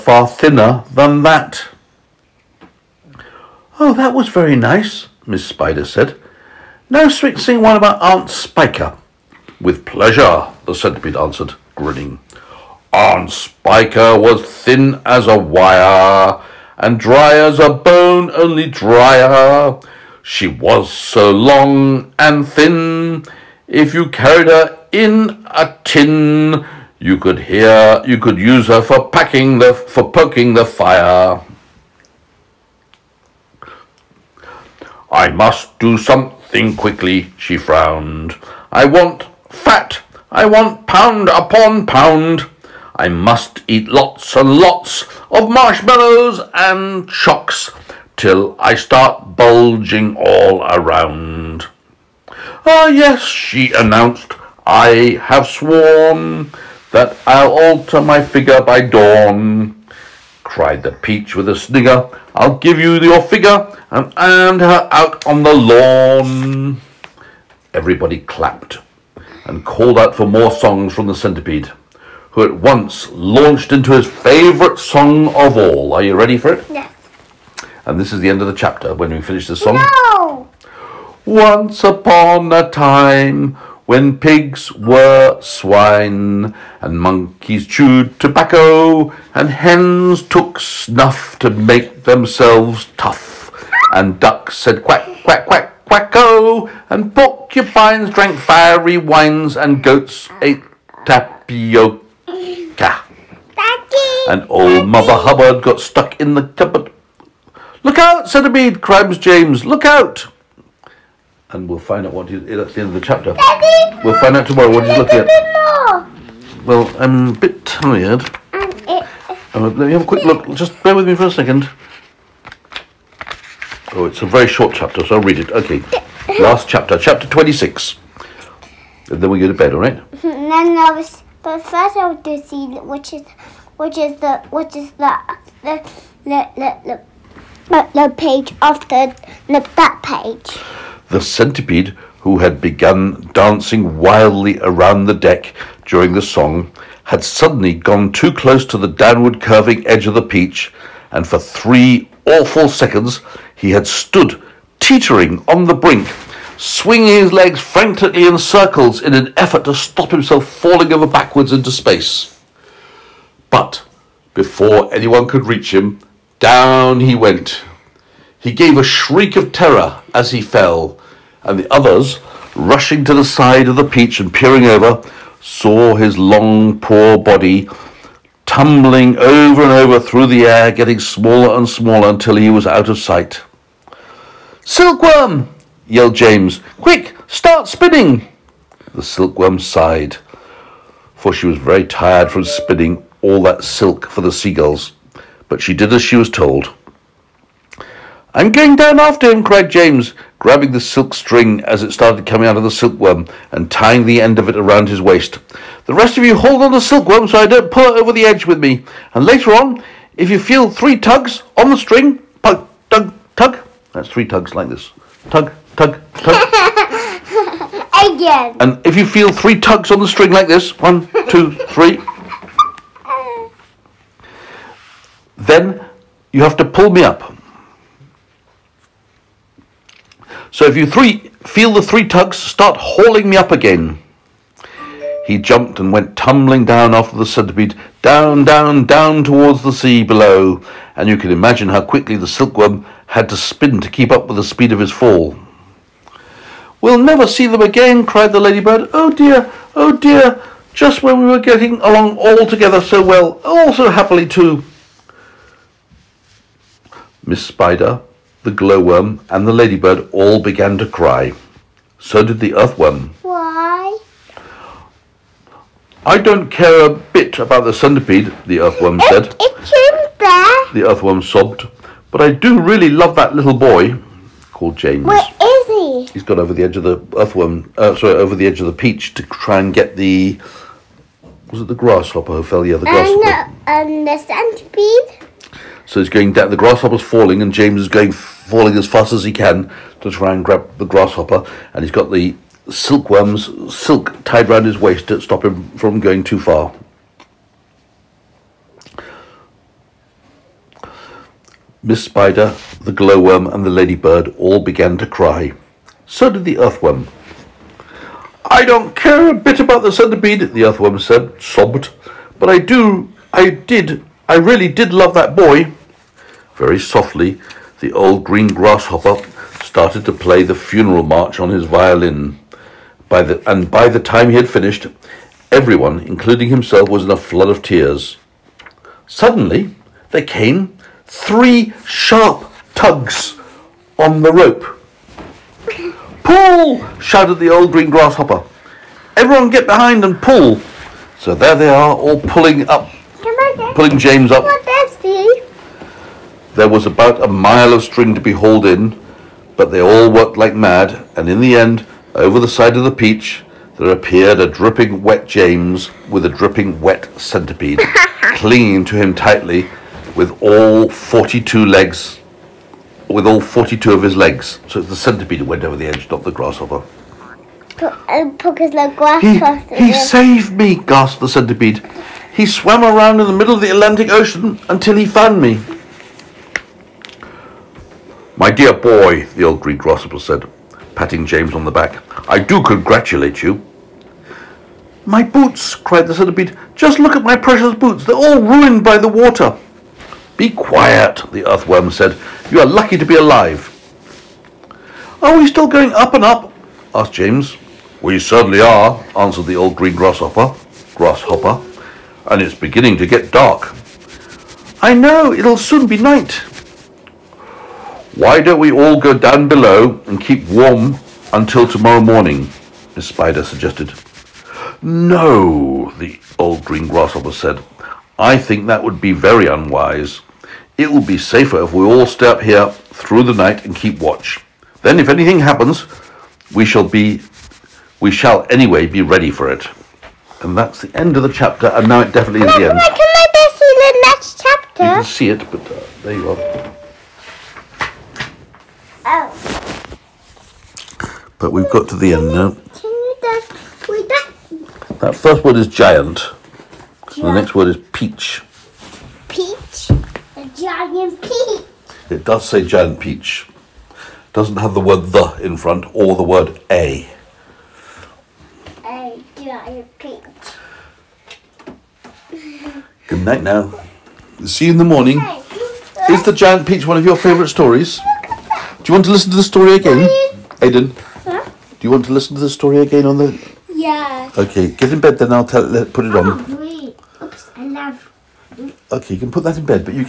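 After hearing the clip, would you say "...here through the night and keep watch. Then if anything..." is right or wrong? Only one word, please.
right.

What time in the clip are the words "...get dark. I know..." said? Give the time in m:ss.
6:43.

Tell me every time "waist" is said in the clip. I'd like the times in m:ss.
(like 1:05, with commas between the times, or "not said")
3:25, 4:54.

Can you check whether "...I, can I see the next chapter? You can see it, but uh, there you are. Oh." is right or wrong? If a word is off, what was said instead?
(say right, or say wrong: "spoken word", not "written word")
right.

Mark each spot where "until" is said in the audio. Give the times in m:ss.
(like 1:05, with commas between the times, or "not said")
3:02, 6:14, 6:51.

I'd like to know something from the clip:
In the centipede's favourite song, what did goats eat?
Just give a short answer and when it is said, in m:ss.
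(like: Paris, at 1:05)
tapioca, at 1:41.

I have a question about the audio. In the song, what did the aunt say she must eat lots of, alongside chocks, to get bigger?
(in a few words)
marshmallows.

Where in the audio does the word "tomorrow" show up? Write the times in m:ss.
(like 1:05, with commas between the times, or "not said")
1:54, 6:51.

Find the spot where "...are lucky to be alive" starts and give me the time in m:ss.
6:32.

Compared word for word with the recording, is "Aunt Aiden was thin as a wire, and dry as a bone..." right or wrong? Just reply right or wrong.
wrong.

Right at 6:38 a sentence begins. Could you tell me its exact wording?
We certainly are, answered the old green grasshopper.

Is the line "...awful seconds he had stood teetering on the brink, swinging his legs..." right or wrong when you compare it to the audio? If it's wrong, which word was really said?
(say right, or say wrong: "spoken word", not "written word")
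right.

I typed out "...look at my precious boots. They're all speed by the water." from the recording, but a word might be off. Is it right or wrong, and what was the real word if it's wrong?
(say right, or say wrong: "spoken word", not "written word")
wrong: "ruined", not "speed".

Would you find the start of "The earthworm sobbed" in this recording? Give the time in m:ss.
4:30.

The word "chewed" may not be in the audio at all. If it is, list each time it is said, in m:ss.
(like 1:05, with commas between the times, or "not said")
1:27.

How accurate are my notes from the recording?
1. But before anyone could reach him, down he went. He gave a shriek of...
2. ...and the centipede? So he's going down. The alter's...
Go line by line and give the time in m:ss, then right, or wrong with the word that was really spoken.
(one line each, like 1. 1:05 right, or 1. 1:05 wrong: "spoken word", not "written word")
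1. 2:43 right
2. 4:43 wrong: "grasshopper", not "alter".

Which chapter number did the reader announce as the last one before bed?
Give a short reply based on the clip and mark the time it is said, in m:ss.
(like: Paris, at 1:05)
26, at 2:06.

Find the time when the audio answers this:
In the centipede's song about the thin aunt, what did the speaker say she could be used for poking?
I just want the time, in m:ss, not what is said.
0:30.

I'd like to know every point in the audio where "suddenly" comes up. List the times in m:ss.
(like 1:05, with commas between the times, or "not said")
2:27, 5:29.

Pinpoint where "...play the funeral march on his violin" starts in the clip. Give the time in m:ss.
5:20.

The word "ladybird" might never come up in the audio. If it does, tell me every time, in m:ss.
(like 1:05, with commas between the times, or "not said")
4:08, 4:19, 5:03.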